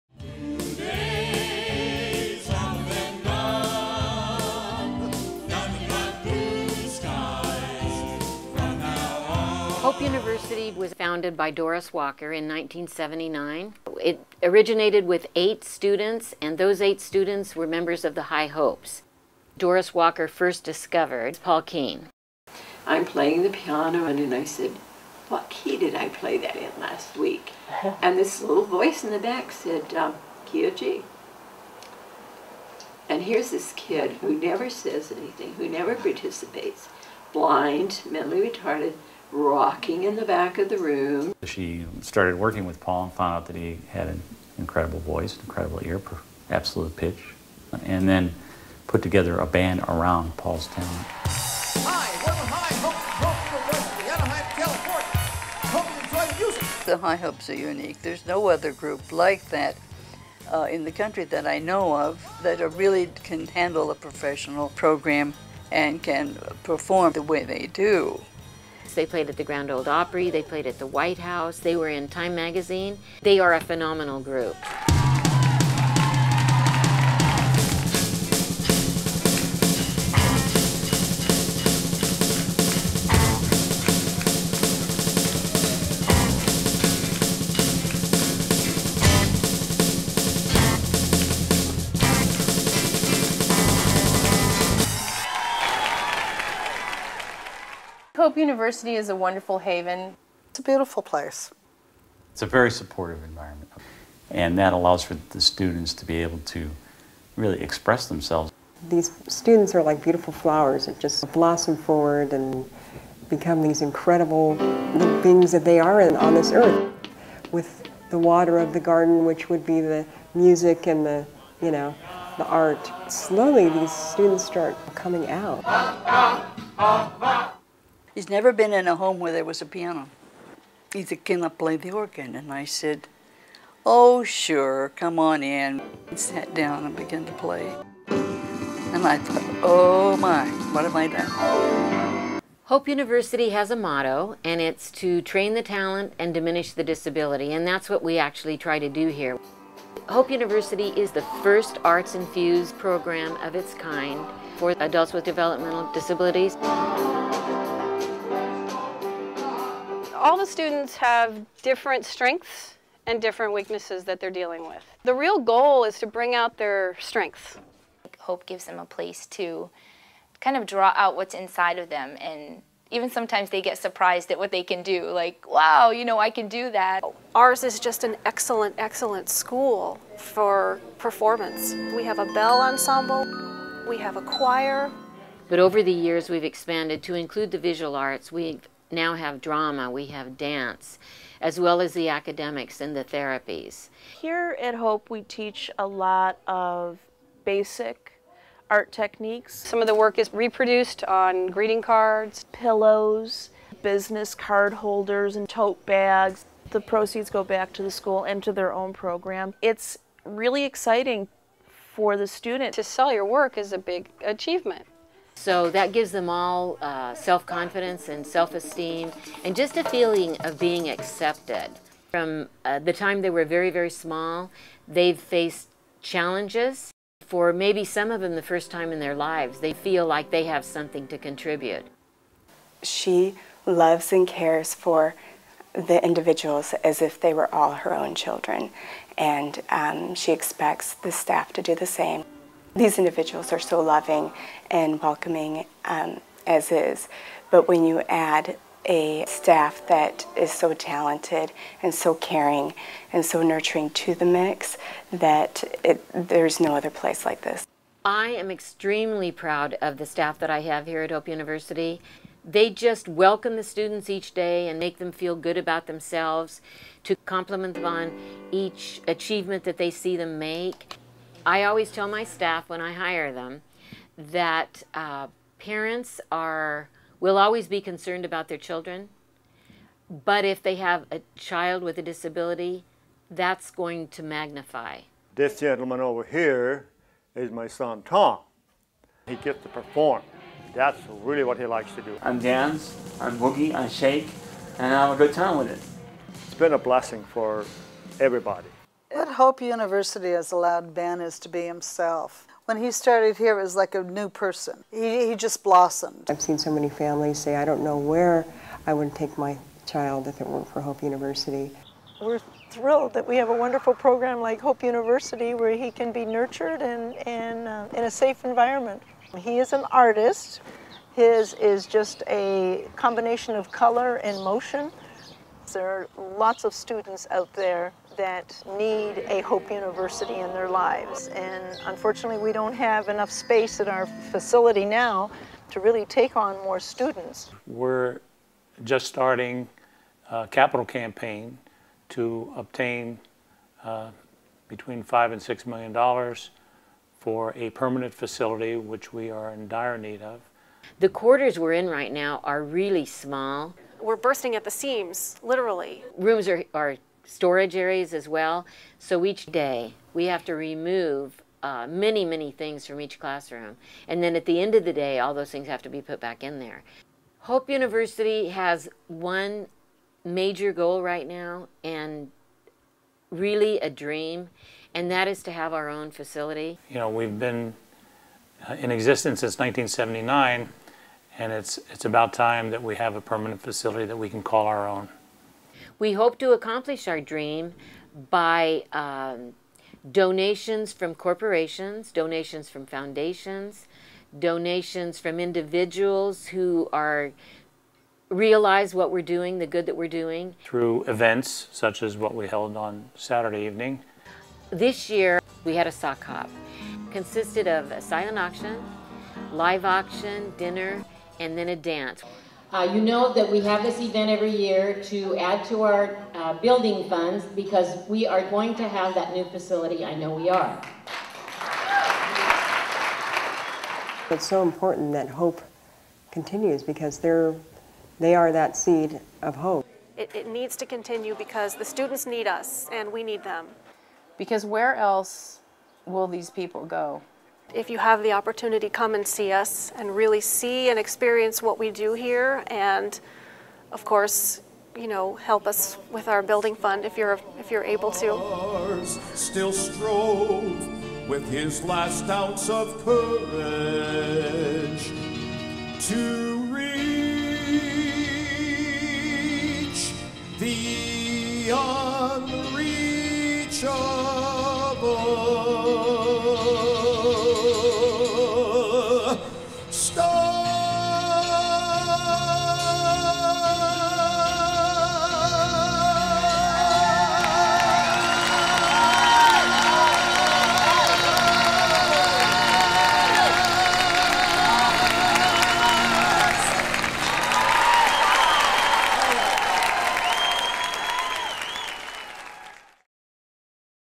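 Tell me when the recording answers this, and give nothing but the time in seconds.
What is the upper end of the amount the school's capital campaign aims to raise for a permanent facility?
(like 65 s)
345 s.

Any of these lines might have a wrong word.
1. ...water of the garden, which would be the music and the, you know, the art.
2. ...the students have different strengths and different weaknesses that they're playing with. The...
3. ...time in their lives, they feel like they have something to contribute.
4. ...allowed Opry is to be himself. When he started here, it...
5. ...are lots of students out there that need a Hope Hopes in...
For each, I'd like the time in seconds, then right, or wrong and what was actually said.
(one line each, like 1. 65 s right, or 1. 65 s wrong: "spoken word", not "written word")
1. 118 s right
2. 160 s wrong: "dealing", not "playing"
3. 228 s right
4. 300 s wrong: "Ben", not "Opry"
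5. 325 s wrong: "University", not "Hopes".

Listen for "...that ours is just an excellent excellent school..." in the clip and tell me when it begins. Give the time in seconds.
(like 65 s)
176 s.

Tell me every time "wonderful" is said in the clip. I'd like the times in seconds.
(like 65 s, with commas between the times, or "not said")
99 s, 313 s.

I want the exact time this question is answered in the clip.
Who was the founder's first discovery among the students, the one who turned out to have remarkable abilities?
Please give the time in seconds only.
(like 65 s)
21 s.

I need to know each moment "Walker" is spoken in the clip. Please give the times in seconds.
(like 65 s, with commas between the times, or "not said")
11 s, 19 s.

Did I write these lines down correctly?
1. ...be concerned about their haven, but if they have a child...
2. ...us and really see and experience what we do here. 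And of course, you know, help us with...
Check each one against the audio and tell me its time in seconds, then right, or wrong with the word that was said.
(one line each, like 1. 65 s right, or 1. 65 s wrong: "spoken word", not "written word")
1. 277 s wrong: "children", not "haven"
2. 439 s right.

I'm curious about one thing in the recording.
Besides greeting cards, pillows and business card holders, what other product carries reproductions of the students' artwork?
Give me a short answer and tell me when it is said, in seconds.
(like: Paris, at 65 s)
Tote bags, at 205 s.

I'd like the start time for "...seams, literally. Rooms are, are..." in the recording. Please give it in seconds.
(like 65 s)
354 s.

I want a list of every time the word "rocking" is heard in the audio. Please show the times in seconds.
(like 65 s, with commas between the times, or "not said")
39 s.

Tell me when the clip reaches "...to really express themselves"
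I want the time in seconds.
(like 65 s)
106 s.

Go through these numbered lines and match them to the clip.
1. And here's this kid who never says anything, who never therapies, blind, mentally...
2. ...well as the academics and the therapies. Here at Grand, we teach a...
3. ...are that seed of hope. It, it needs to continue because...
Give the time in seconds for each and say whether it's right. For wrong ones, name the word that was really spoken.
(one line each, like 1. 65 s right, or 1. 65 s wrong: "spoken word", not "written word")
1. 33 s wrong: "participates", not "therapies"
2. 191 s wrong: "Hope", not "Grand"
3. 428 s right.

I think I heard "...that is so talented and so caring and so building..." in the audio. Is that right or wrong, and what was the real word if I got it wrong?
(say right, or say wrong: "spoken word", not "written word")
wrong: "nurturing", not "building".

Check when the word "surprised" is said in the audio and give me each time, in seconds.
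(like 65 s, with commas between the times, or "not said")
173 s.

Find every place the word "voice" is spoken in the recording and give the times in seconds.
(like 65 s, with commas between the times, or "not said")
28 s, 44 s.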